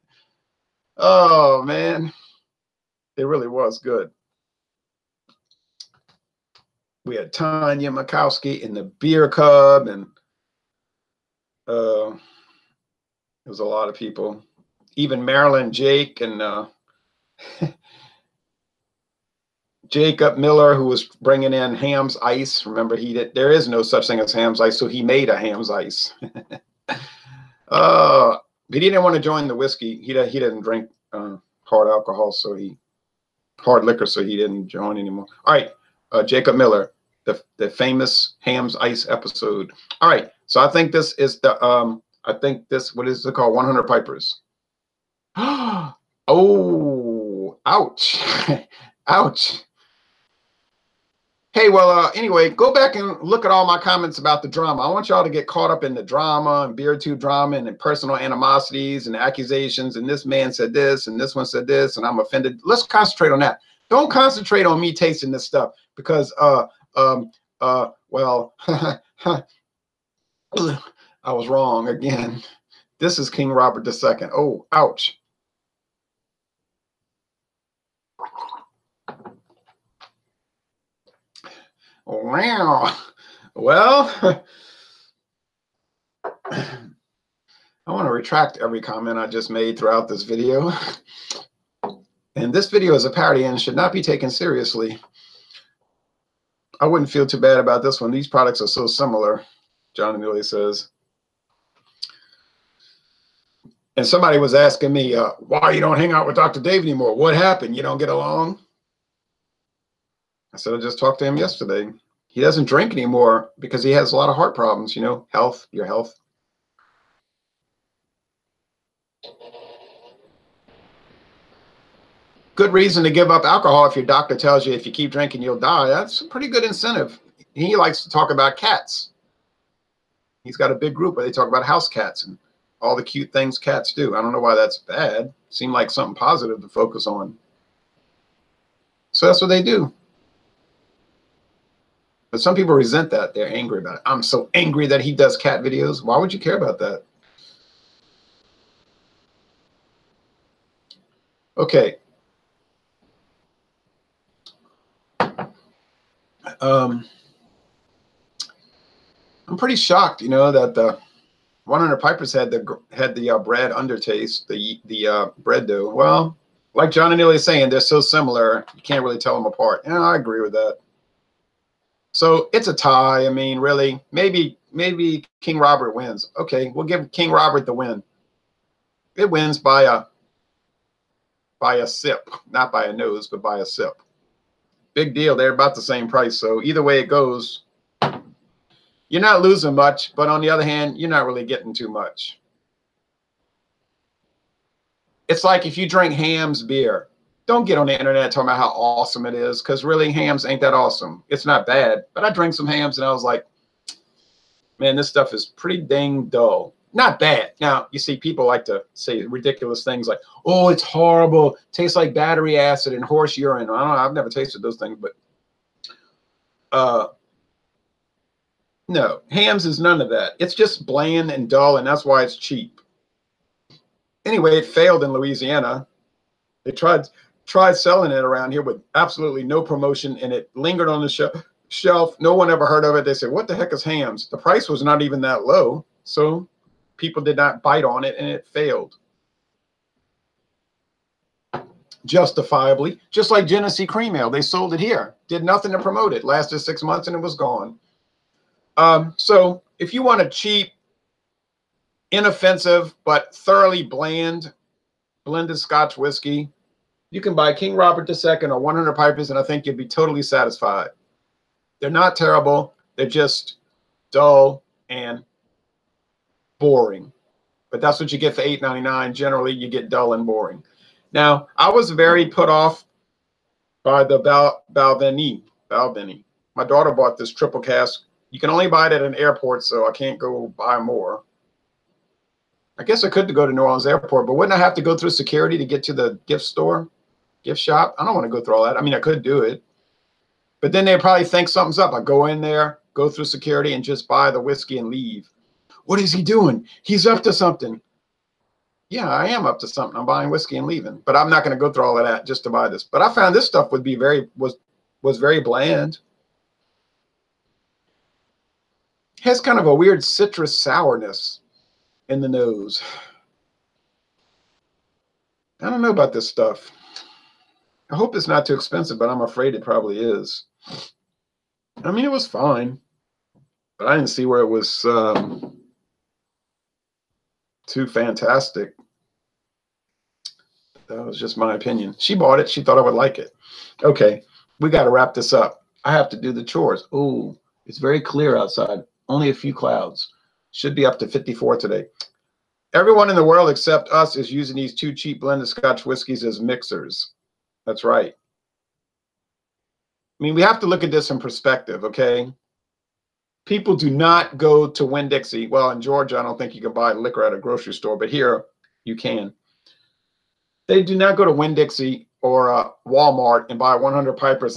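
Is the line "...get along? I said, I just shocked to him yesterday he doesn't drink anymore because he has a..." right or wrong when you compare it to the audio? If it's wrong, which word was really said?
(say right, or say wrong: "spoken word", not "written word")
wrong: "talked", not "shocked".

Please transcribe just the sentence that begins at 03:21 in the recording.
It's not bad, but I drank some Hamm's and I was like, man, this stuff is pretty dang dull.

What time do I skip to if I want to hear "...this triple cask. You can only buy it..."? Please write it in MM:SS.
04:37.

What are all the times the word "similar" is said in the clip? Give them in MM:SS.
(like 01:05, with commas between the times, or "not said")
01:38, 02:48.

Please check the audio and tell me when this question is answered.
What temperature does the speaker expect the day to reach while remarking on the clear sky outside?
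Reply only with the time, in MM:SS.
05:41.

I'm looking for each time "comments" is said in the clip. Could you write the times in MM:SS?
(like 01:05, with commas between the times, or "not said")
00:53, 01:28.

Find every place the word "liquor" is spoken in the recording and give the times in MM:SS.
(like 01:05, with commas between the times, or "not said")
00:33, 05:56.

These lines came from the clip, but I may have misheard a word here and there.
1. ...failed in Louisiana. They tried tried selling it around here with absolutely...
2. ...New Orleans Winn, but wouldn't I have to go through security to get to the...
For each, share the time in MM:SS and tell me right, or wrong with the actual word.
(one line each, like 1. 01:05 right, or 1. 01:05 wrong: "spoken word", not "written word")
1. 03:44 right
2. 04:43 wrong: "Airport", not "Winn".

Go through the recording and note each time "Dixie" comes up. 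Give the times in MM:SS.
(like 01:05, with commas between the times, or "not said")
05:55, 06:01.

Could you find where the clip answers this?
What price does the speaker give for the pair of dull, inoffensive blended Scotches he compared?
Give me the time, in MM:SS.
04:28.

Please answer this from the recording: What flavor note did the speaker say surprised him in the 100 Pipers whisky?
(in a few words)
Bread dough.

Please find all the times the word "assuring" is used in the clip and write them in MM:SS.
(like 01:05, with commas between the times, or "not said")
not said.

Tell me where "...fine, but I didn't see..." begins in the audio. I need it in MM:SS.
05:22.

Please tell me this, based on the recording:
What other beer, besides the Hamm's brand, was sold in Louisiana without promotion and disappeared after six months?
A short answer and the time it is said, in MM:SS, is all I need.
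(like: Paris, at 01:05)
Genesee Cream Ale, at 04:03.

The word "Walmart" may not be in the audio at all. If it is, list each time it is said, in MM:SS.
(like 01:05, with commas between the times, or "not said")
06:02.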